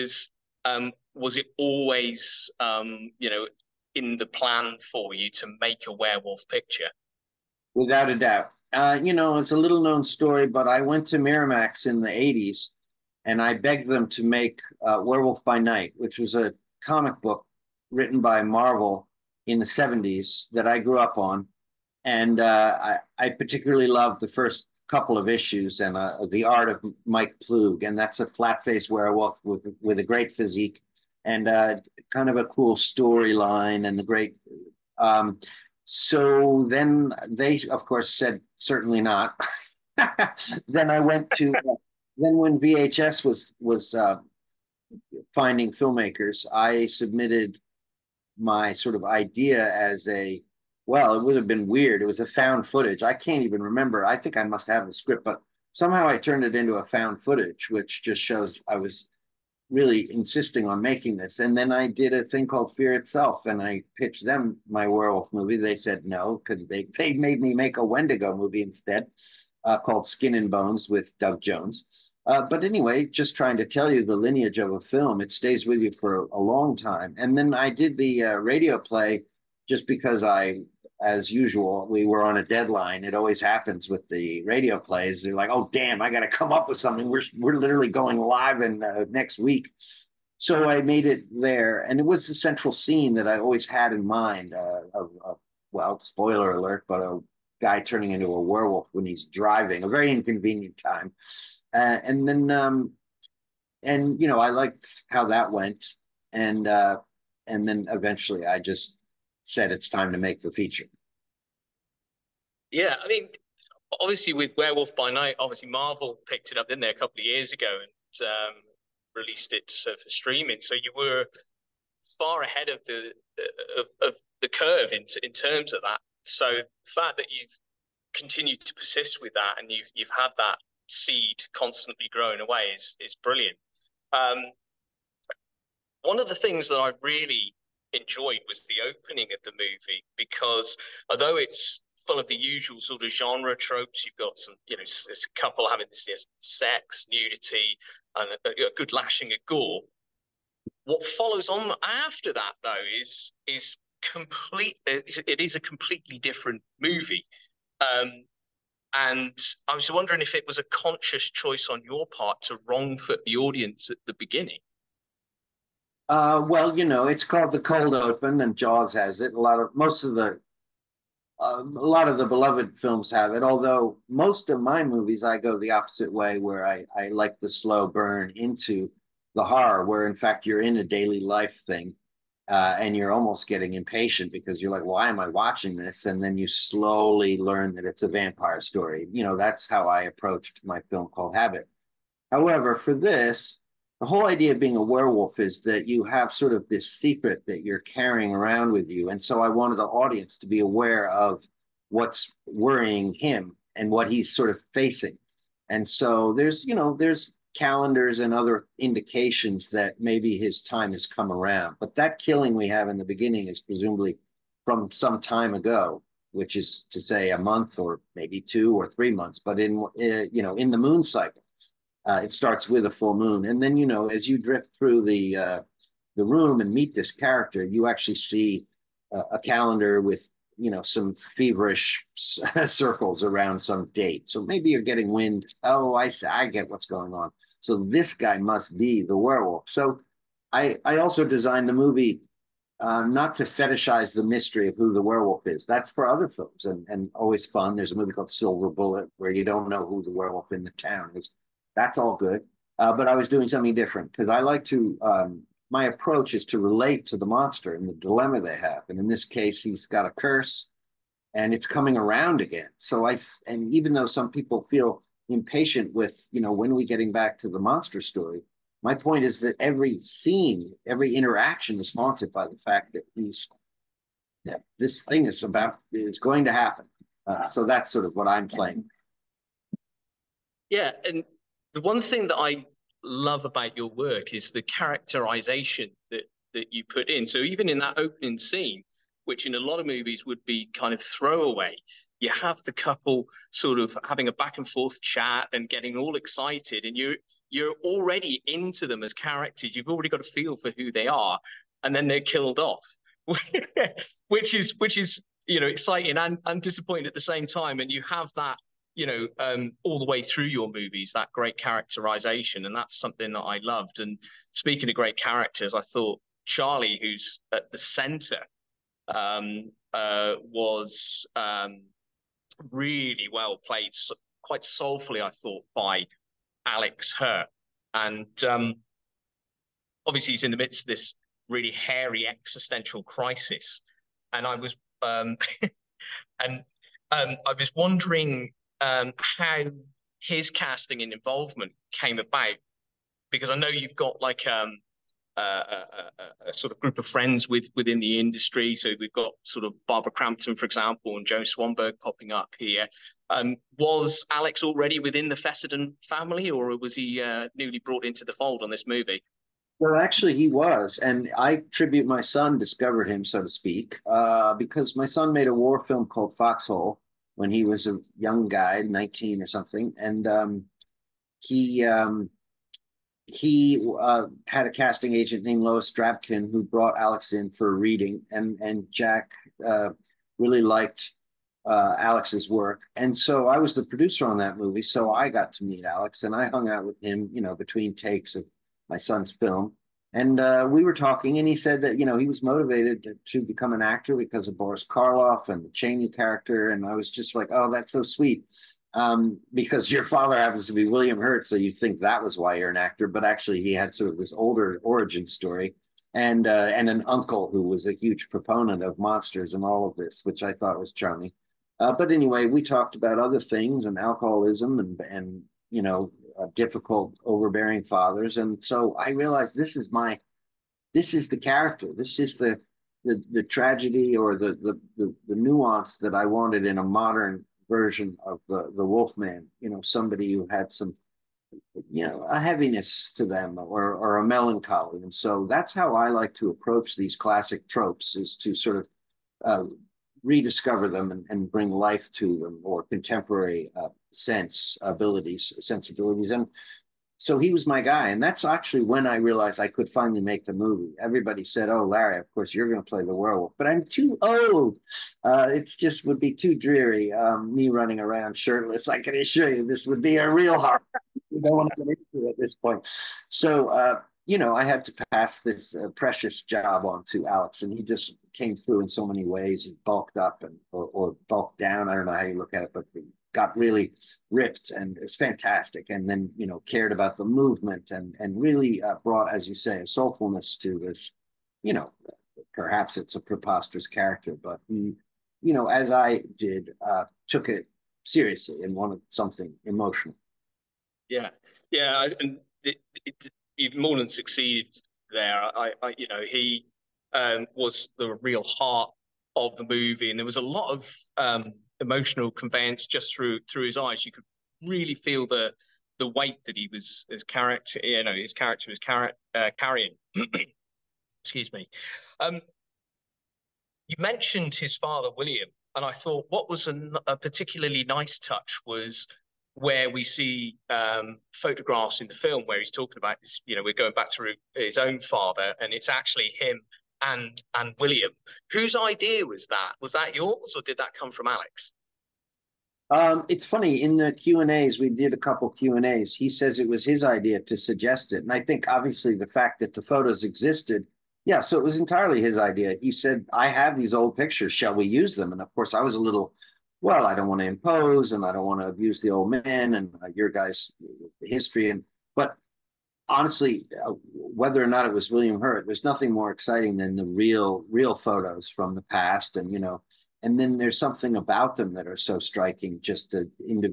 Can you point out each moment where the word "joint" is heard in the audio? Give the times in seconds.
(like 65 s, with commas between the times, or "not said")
not said.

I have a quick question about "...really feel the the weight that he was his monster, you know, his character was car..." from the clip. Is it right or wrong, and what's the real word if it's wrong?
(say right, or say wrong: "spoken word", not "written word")
wrong: "character", not "monster".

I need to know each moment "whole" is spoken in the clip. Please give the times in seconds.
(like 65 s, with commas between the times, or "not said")
194 s.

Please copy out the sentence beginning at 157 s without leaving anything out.
Um, and I was wondering if it was a conscious choice on your part to wrong foot the audience at the beginning.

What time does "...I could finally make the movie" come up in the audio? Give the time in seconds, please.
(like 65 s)
449 s.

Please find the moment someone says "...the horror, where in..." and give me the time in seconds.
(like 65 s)
179 s.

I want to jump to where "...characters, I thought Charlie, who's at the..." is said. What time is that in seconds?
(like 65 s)
315 s.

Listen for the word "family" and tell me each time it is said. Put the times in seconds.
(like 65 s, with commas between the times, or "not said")
356 s.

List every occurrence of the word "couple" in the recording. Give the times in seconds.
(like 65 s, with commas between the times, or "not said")
24 s, 116 s, 145 s, 292 s, 535 s.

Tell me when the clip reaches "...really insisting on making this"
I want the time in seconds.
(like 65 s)
59 s.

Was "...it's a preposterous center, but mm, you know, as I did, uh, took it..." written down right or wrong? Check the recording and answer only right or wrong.
wrong.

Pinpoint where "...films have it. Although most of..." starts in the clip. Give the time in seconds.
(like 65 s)
172 s.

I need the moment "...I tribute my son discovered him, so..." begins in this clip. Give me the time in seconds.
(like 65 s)
361 s.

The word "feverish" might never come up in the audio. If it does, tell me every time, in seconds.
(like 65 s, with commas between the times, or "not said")
231 s.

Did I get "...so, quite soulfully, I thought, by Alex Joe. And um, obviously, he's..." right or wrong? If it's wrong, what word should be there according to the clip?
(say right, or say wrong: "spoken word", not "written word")
wrong: "Hurt", not "Joe".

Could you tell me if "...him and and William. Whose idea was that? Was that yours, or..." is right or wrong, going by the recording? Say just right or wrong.
right.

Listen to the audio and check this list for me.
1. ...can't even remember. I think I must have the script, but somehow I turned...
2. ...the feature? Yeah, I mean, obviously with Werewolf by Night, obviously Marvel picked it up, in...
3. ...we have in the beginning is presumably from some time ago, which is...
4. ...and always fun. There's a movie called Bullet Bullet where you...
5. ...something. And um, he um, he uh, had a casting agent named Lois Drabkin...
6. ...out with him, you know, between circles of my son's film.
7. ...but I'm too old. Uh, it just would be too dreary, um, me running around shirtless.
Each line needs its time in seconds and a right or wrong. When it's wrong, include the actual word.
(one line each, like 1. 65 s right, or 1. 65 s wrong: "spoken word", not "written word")
1. 53 s right
2. 110 s right
3. 212 s right
4. 246 s wrong: "Silver", not "Bullet"
5. 369 s right
6. 386 s wrong: "takes", not "circles"
7. 453 s right.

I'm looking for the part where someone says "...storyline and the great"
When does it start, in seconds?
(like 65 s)
32 s.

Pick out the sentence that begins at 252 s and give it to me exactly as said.
Uh, but I was doing something different because I like to.